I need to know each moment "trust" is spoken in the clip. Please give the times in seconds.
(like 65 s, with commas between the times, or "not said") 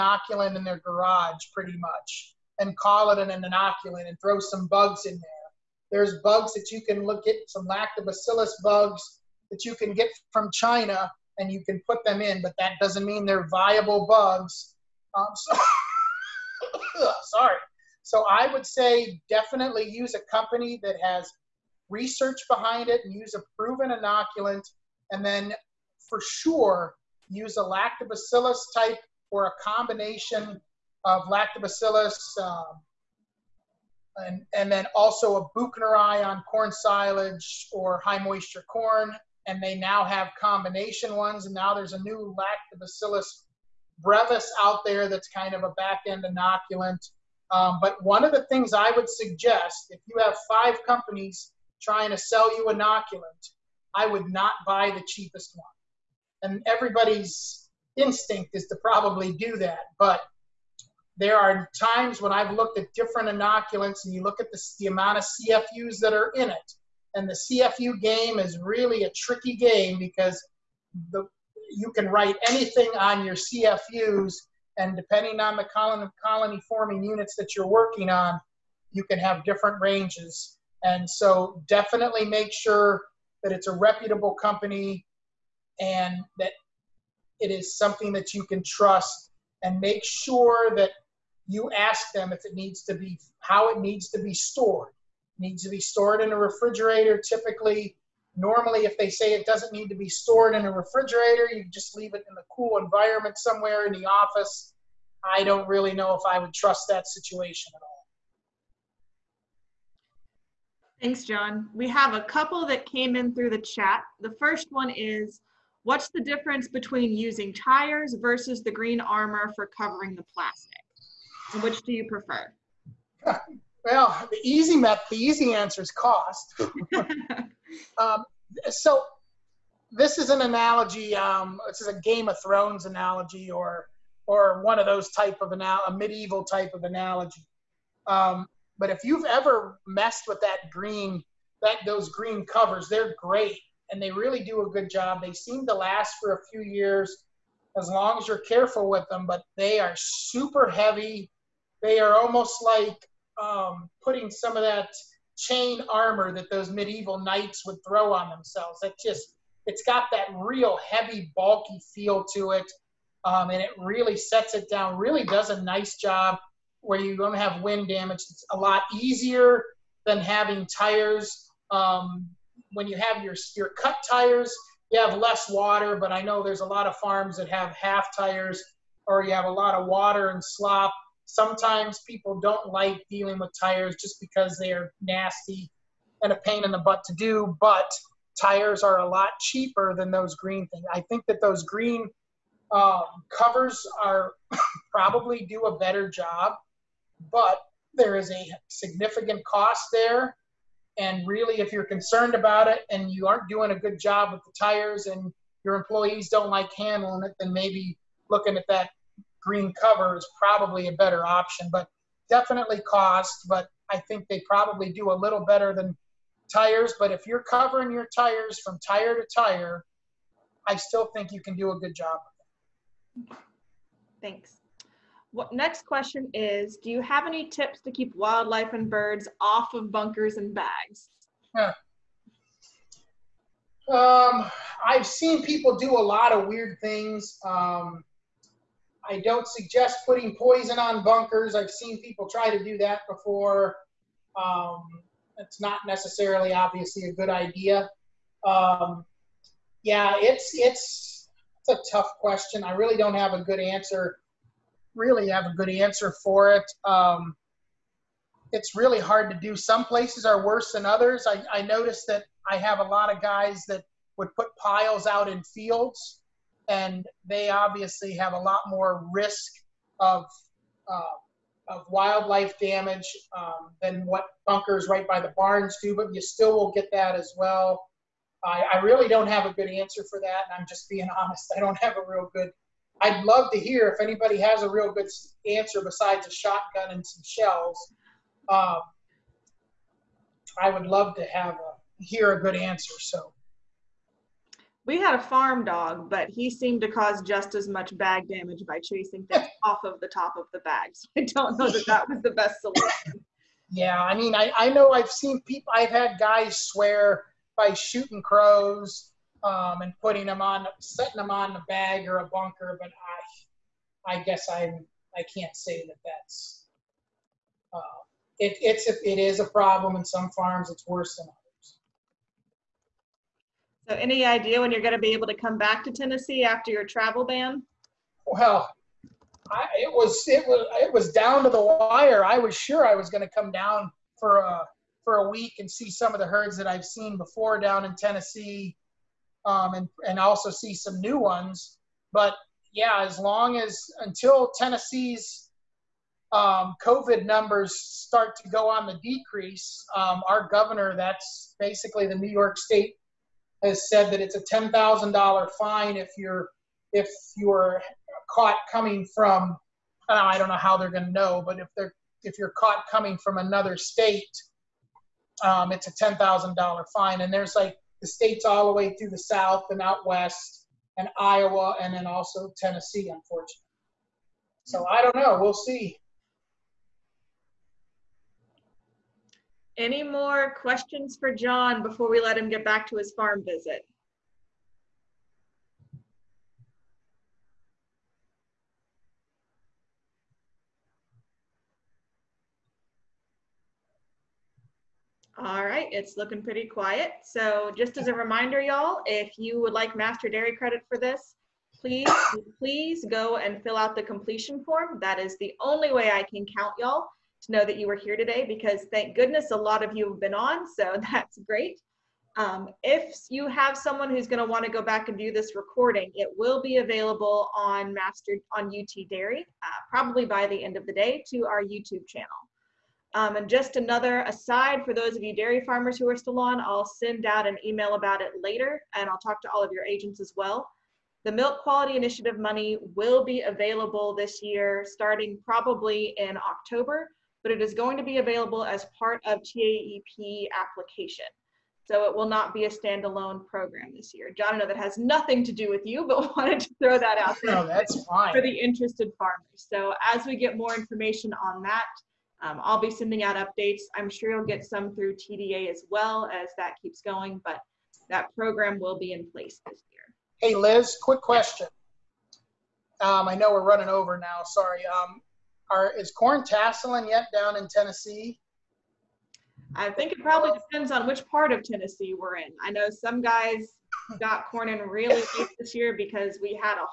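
88 s, 106 s.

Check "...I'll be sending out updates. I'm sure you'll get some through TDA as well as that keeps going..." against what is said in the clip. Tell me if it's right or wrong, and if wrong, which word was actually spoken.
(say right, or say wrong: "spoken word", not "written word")
right.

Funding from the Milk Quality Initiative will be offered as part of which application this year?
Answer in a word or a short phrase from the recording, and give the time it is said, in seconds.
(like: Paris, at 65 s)
TAEP, at 439 s.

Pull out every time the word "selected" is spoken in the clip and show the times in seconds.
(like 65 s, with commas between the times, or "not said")
not said.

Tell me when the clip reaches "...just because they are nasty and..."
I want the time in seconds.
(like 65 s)
183 s.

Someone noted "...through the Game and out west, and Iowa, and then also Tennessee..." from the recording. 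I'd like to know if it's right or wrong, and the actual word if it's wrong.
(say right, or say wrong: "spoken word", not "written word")
wrong: "South", not "Game".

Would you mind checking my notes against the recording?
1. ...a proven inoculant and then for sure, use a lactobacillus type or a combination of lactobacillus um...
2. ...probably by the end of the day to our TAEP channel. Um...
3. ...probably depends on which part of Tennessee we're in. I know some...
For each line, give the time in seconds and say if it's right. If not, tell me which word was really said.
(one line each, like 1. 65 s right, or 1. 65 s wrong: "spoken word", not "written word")
1. 23 s right
2. 419 s wrong: "YouTube", not "TAEP"
3. 470 s right.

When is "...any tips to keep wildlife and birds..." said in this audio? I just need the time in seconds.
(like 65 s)
227 s.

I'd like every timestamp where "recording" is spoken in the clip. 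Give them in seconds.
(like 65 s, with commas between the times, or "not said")
415 s.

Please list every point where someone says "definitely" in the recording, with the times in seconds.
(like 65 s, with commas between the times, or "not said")
19 s, 81 s, 212 s.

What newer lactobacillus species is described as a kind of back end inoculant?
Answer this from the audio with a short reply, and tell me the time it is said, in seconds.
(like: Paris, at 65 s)
lactobacillus brevis, at 42 s.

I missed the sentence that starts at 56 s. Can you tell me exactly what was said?
And everybody's instinct is to probably do that.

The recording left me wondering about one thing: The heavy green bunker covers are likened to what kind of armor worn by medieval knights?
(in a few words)
chain armor.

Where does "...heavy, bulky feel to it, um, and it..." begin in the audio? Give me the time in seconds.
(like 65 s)
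160 s.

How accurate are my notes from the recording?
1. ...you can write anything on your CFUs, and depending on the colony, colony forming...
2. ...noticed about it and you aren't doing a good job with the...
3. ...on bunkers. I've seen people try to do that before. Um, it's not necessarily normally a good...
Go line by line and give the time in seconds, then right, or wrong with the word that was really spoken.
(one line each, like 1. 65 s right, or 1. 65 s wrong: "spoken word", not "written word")
1. 71 s right
2. 201 s wrong: "concerned", not "noticed"
3. 240 s wrong: "obviously", not "normally".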